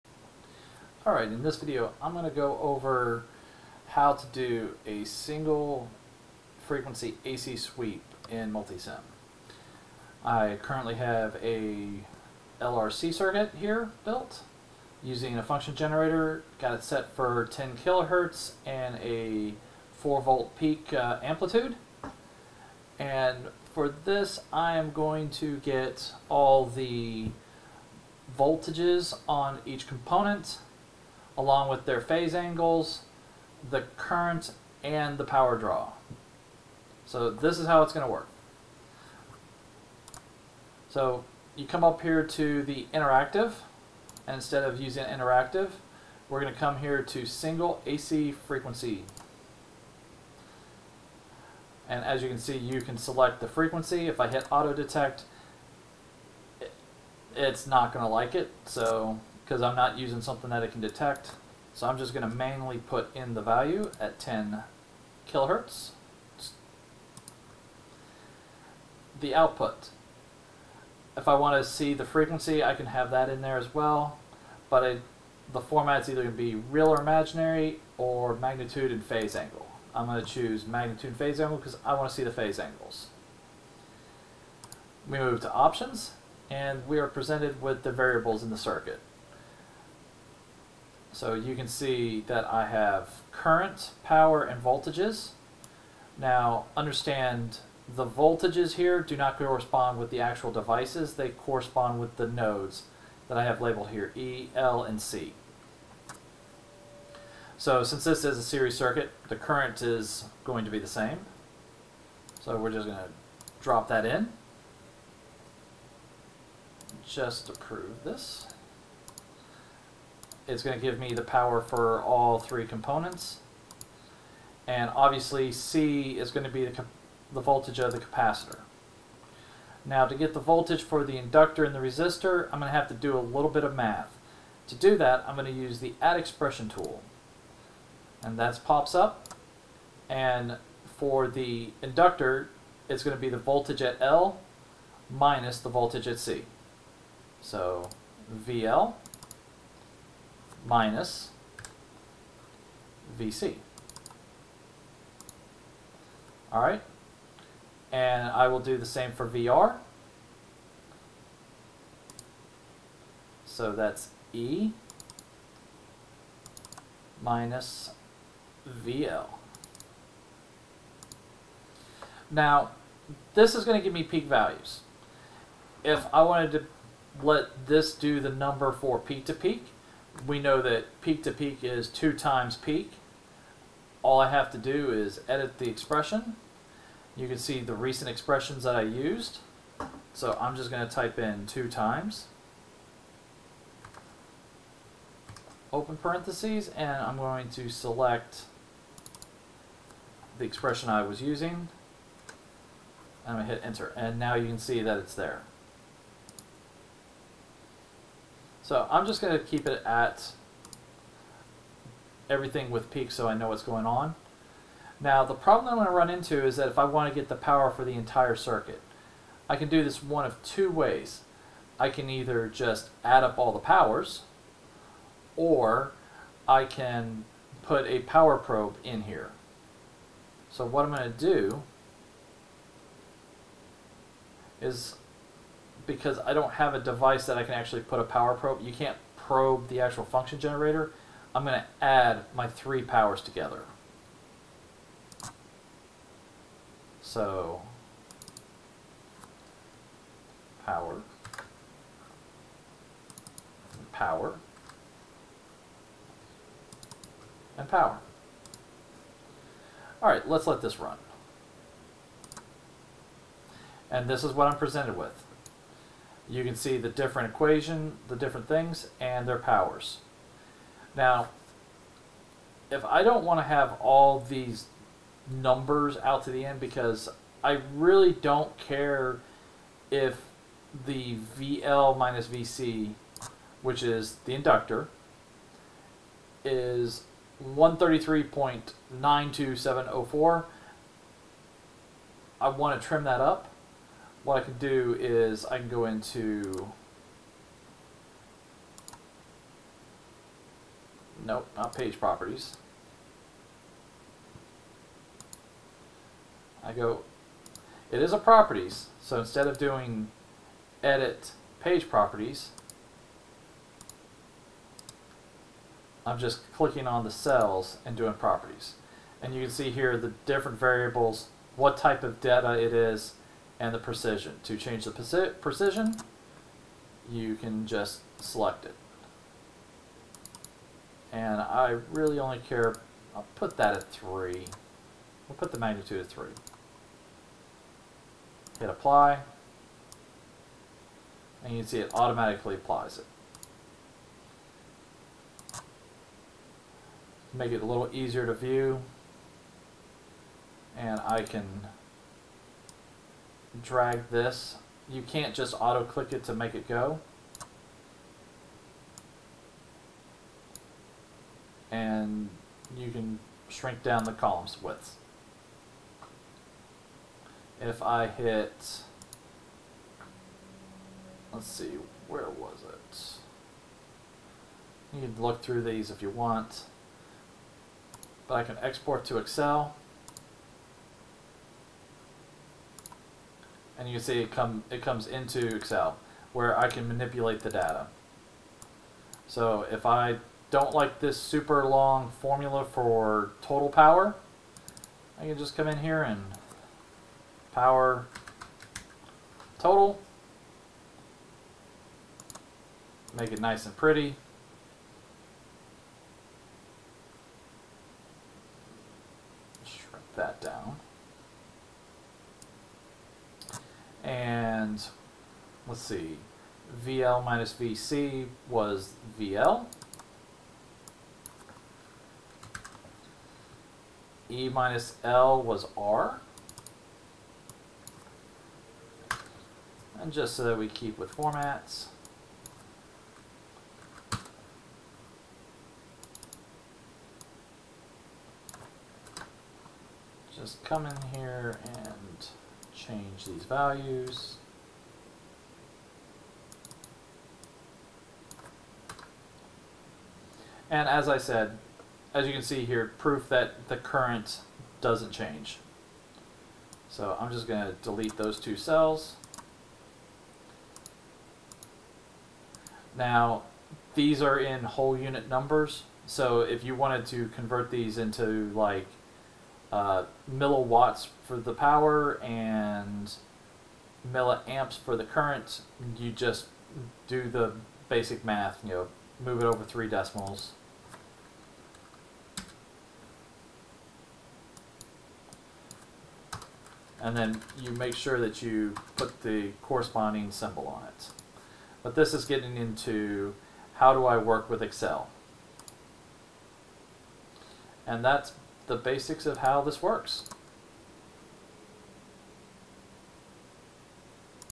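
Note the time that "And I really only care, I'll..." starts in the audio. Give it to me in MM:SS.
05:31.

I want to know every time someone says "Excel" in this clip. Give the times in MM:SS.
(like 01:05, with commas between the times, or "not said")
06:19, 06:25, 08:14.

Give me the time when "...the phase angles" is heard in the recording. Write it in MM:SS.
01:22.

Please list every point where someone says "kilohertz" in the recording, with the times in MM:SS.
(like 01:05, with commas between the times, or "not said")
00:17, 01:05.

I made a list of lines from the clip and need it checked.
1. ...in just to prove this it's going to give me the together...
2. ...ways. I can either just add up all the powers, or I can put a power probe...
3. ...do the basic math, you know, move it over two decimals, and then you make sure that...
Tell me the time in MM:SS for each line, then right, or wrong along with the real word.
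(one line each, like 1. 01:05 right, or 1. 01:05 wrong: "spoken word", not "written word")
1. 01:54 wrong: "power", not "together"
2. 03:40 right
3. 07:57 wrong: "three", not "two".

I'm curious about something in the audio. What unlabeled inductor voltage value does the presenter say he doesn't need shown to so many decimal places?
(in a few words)
133.92704.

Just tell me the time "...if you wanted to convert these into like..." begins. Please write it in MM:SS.
07:46.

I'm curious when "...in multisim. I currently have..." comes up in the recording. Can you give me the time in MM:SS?
00:08.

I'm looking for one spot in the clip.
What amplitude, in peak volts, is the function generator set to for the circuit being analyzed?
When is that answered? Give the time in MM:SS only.
00:19.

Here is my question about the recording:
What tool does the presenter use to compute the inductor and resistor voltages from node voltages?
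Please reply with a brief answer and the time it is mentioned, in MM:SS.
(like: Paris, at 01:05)
add expression tool, at 02:16.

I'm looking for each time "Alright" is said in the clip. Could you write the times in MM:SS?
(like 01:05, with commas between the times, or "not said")
00:01.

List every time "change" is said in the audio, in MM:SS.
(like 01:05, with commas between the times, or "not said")
05:24, 07:22, 07:35.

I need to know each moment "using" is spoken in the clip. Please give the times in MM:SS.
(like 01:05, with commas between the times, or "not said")
00:15, 00:44, 00:59, 03:21.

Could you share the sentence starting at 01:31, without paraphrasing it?
So you can see that I have current, power, and voltages.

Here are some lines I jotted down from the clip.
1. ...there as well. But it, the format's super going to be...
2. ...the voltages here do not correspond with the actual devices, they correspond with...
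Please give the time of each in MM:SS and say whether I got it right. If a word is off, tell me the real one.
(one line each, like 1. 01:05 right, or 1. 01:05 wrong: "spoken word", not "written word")
1. 01:13 wrong: "either", not "super"
2. 01:37 right.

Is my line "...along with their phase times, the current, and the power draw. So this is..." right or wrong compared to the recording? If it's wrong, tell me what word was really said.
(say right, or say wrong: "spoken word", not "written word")
wrong: "angles", not "times".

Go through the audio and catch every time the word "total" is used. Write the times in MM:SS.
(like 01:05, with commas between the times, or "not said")
06:33, 06:39.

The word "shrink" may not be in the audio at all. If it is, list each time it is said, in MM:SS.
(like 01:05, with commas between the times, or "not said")
06:03, 06:49.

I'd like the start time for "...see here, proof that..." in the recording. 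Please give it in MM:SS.
07:32.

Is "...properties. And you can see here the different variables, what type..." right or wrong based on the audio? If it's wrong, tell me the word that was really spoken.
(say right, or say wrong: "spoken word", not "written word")
right.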